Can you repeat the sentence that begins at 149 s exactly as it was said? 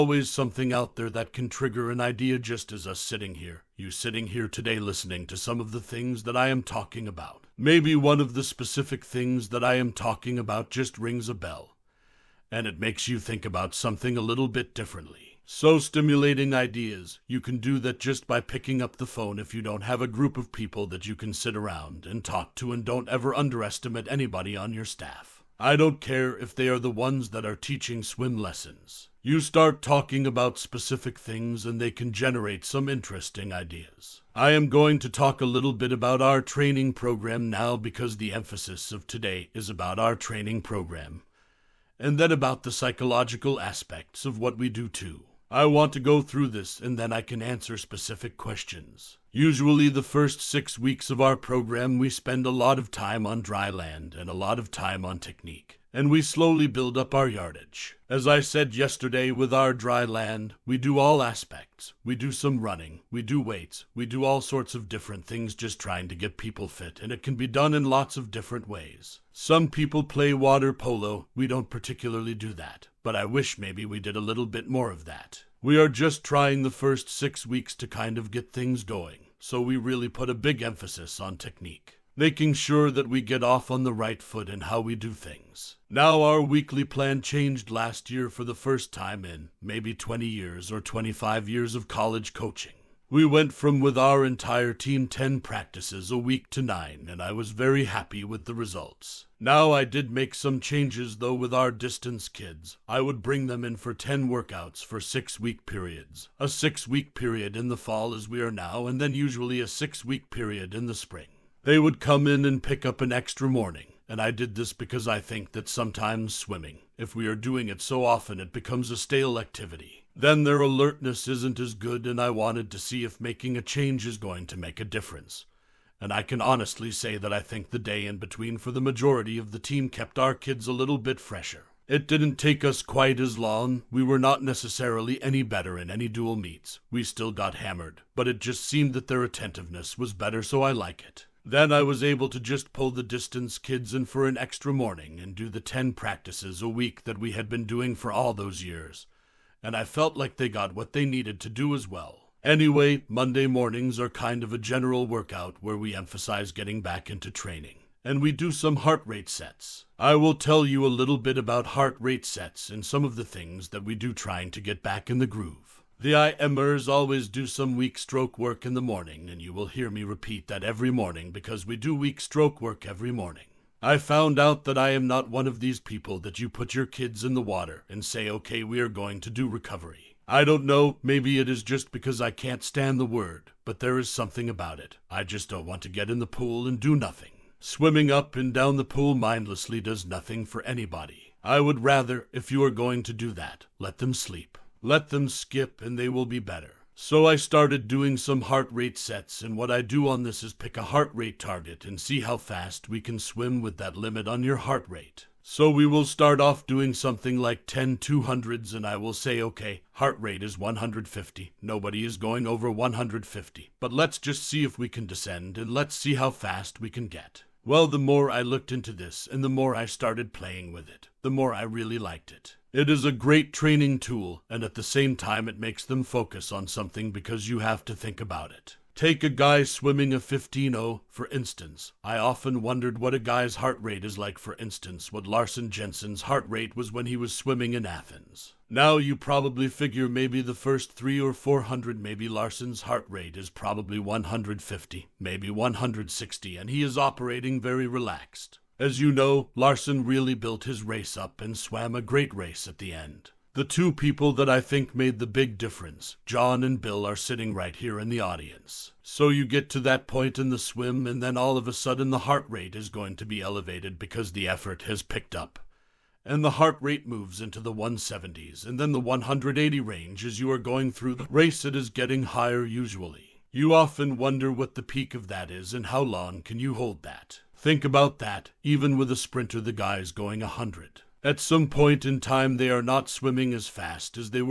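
And I felt like they got what they needed to do as well.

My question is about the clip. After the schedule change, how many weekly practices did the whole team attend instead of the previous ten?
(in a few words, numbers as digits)
9.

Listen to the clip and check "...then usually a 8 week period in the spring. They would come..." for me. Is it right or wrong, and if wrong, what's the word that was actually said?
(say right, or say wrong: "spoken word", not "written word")
wrong: "6", not "8".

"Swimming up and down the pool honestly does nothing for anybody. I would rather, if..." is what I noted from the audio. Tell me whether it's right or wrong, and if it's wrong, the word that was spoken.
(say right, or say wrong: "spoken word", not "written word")
wrong: "mindlessly", not "honestly".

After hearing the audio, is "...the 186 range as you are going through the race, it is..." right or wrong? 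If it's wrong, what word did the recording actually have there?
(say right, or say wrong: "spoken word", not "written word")
wrong: "180", not "186".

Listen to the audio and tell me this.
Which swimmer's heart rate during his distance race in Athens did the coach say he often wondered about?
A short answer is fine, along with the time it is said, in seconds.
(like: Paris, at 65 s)
Larsen Jensen, at 235 s.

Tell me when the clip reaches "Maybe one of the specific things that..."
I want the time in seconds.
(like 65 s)
7 s.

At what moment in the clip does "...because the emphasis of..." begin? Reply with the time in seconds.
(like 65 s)
37 s.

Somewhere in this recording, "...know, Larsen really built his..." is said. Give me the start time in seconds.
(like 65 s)
249 s.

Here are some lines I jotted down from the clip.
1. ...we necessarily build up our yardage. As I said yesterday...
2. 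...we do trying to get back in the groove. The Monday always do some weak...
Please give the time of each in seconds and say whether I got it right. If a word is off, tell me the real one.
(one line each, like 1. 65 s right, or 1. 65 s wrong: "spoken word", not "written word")
1. 56 s wrong: "slowly", not "necessarily"
2. 163 s wrong: "IMers", not "Monday".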